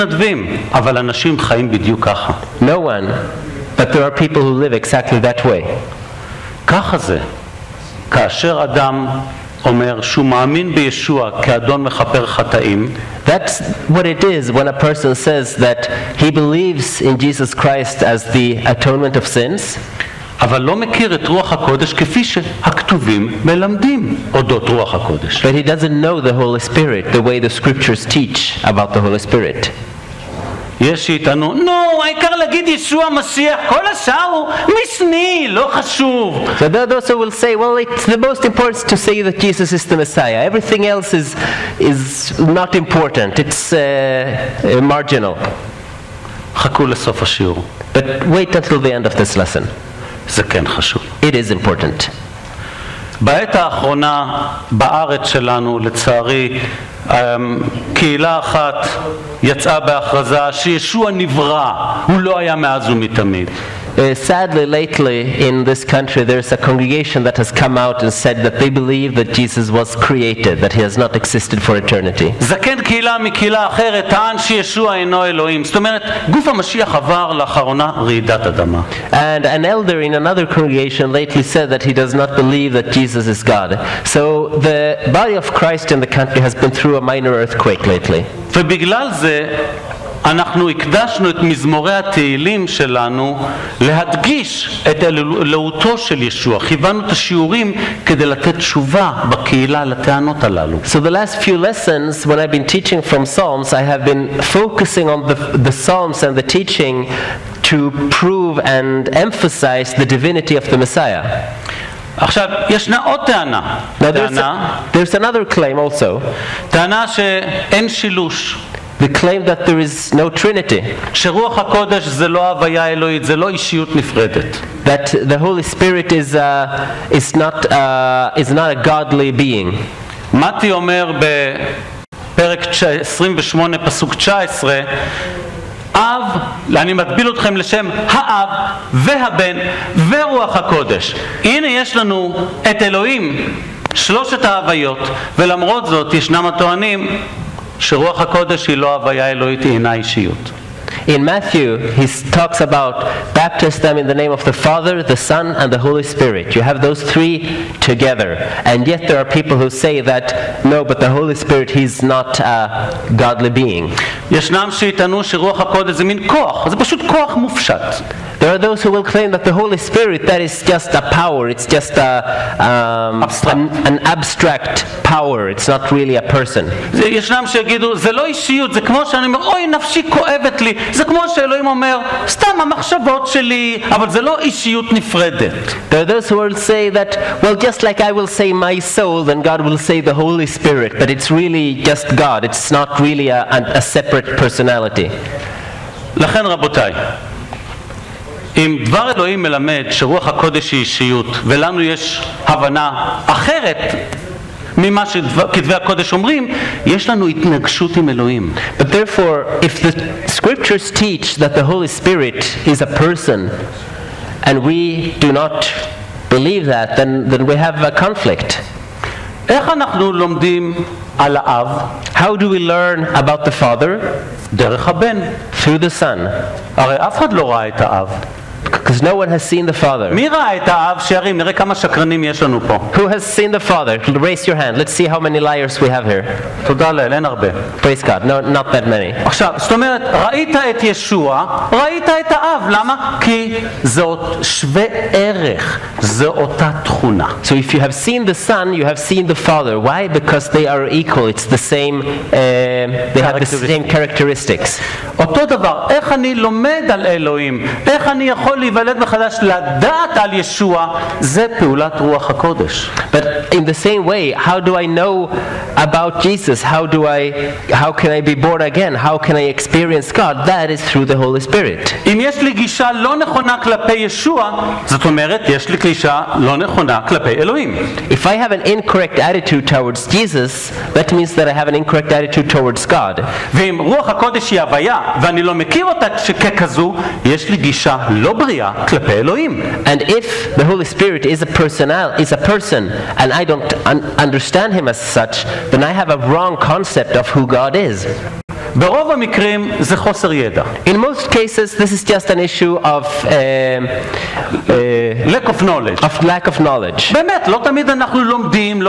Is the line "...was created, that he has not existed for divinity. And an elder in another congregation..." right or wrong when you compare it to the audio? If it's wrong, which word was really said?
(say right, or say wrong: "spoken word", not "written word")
wrong: "eternity", not "divinity".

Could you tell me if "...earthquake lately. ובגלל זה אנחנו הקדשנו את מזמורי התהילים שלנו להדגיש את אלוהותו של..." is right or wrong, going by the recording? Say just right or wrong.
right.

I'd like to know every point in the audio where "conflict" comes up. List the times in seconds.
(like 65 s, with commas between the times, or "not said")
217 s.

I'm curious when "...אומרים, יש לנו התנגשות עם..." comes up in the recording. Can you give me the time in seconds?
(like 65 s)
206 s.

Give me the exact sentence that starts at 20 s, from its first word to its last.
אבל לא מכיר את רוח הקודש כפי שהכתובים מלמדים אודות רוח הקודש.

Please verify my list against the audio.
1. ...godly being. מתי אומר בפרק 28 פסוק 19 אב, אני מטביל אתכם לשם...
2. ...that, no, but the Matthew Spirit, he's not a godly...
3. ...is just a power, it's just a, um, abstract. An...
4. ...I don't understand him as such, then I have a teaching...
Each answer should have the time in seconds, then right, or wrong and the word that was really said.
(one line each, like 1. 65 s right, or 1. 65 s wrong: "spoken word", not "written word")
1. 128 s right
2. 159 s wrong: "Holy", not "Matthew"
3. 170 s right
4. 293 s wrong: "wrong", not "teaching".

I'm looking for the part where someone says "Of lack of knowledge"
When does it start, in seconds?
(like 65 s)
306 s.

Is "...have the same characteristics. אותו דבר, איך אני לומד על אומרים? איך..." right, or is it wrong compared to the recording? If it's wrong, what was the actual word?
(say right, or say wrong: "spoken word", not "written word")
wrong: "אלוהים", not "אומרים".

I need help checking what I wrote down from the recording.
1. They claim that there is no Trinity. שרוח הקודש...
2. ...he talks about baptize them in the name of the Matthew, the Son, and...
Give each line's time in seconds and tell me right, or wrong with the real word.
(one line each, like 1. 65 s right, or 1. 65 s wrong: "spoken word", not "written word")
1. 118 s right
2. 151 s wrong: "Father", not "Matthew".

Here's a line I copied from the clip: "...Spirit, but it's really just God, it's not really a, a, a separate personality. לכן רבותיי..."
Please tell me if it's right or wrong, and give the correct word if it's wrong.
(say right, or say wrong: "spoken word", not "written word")
right.